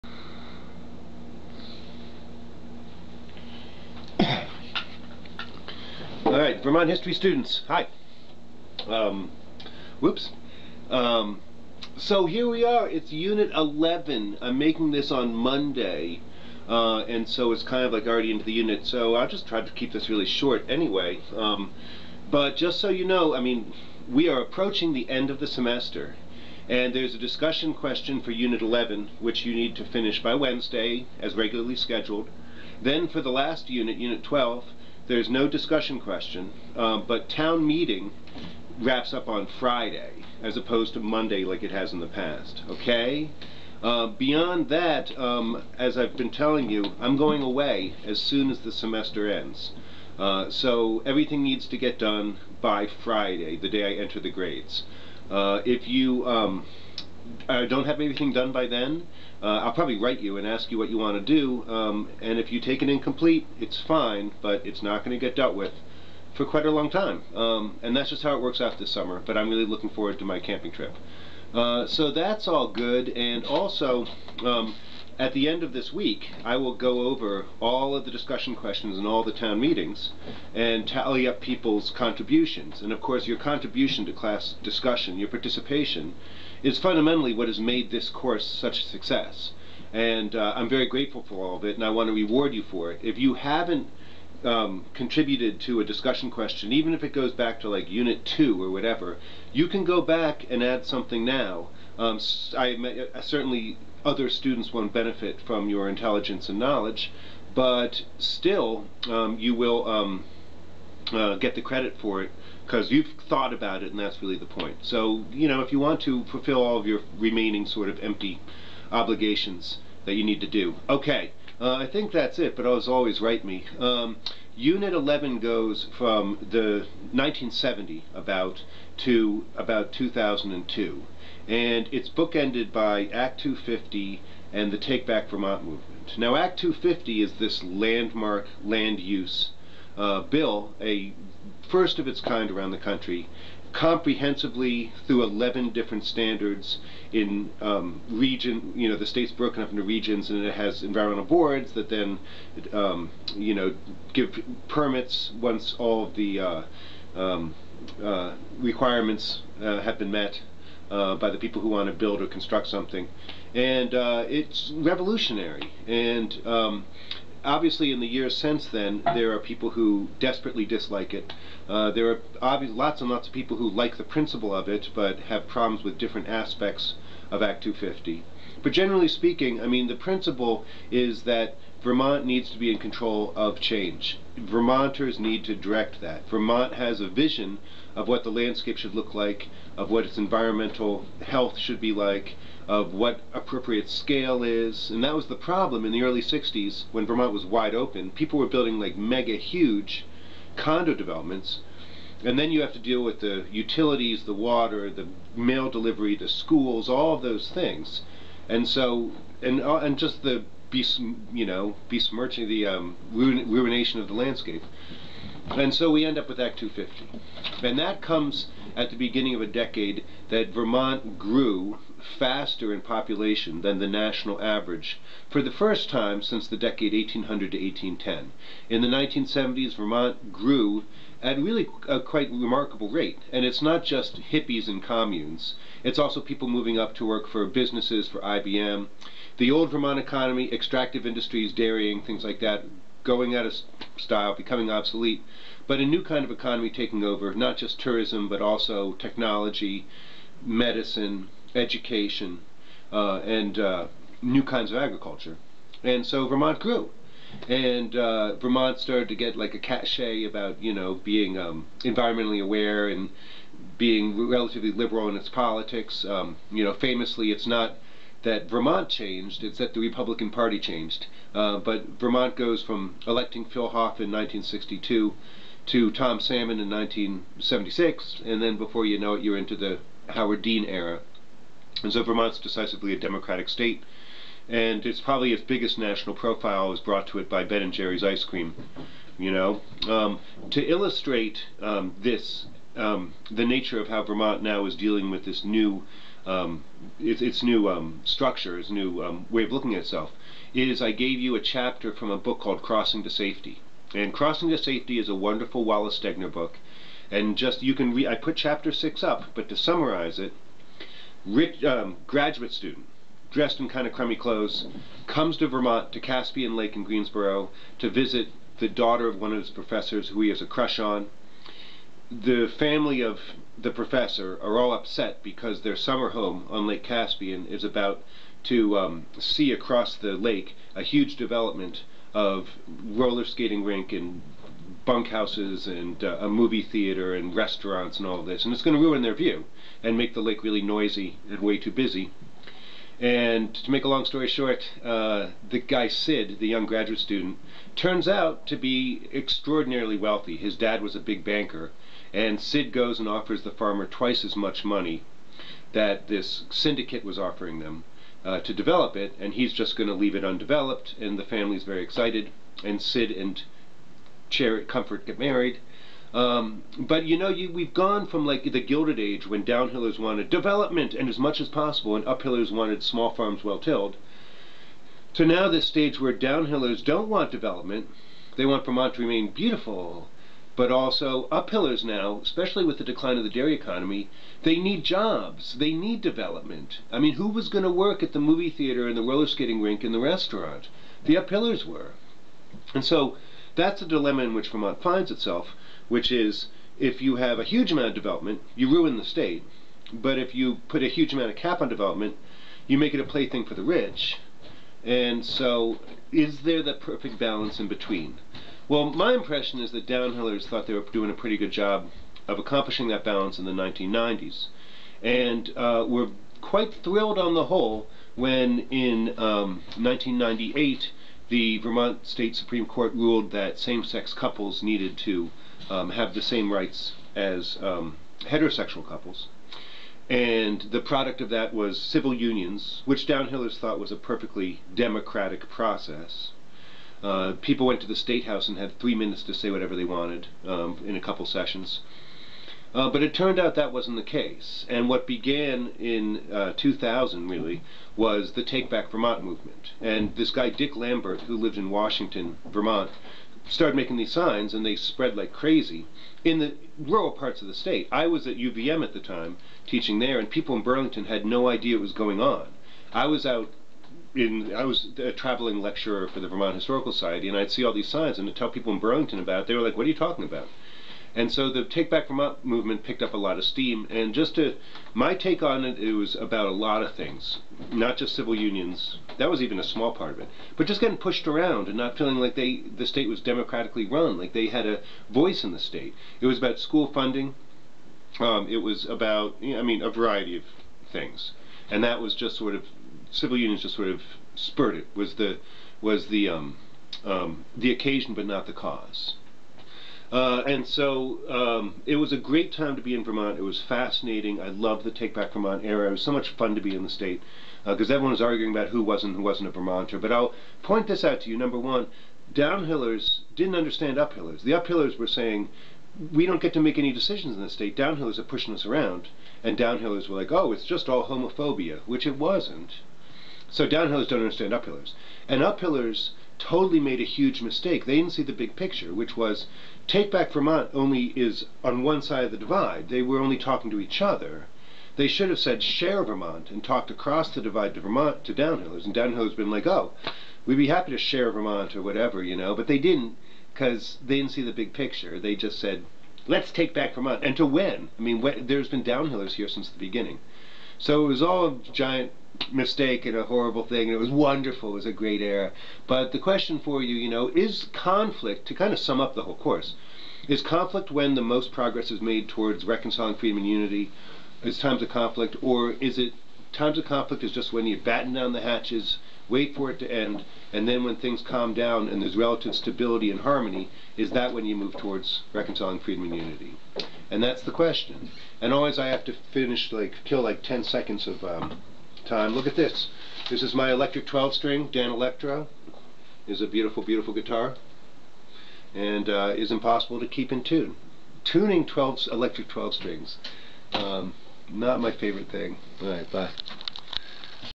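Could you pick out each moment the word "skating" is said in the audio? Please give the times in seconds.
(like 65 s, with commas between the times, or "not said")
333 s, 389 s.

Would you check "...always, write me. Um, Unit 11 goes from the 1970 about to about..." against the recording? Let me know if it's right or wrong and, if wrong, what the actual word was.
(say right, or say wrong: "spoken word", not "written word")
right.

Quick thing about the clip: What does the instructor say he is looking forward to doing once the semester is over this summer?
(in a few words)
Camping trip.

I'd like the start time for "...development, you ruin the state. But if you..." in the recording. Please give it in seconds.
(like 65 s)
397 s.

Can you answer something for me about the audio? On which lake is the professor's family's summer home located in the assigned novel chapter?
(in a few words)
Caspian Lake.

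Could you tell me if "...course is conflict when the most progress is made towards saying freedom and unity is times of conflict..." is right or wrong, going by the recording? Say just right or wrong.
wrong.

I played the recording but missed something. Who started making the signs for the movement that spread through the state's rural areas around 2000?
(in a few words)
Dick Lambert.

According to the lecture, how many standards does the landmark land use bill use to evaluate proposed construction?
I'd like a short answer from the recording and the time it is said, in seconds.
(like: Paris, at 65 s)
11, at 145 s.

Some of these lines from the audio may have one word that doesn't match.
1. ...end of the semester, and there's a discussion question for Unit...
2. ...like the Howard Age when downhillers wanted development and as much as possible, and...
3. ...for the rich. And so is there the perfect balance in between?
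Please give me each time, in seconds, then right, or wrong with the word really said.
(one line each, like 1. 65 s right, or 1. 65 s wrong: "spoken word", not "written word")
1. 25 s right
2. 368 s wrong: "Gilded", not "Howard"
3. 403 s right.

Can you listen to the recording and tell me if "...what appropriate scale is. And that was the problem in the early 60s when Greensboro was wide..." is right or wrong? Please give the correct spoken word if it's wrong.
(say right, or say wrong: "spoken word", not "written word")
wrong: "Vermont", not "Greensboro".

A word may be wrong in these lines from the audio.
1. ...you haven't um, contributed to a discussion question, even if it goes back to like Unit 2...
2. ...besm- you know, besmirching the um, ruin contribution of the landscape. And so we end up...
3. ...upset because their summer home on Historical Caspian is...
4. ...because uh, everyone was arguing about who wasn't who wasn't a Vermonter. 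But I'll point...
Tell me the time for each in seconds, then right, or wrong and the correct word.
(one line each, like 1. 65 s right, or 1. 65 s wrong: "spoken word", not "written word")
1. 93 s right
2. 210 s wrong: "ruination", not "contribution"
3. 324 s wrong: "Lake", not "Historical"
4. 507 s right.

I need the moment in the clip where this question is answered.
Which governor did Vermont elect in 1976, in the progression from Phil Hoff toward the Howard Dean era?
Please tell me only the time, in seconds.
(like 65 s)
275 s.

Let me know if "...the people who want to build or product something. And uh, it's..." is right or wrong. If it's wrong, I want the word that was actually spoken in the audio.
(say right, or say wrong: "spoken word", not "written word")
wrong: "construct", not "product".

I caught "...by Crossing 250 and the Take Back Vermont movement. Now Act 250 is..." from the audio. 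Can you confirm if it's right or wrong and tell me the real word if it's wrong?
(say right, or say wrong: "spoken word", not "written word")
wrong: "Act", not "Crossing".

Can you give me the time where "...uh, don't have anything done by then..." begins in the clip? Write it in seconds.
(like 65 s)
57 s.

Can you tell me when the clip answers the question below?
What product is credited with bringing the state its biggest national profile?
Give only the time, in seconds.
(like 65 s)
287 s.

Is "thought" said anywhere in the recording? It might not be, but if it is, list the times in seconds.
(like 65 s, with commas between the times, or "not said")
113 s, 410 s, 433 s.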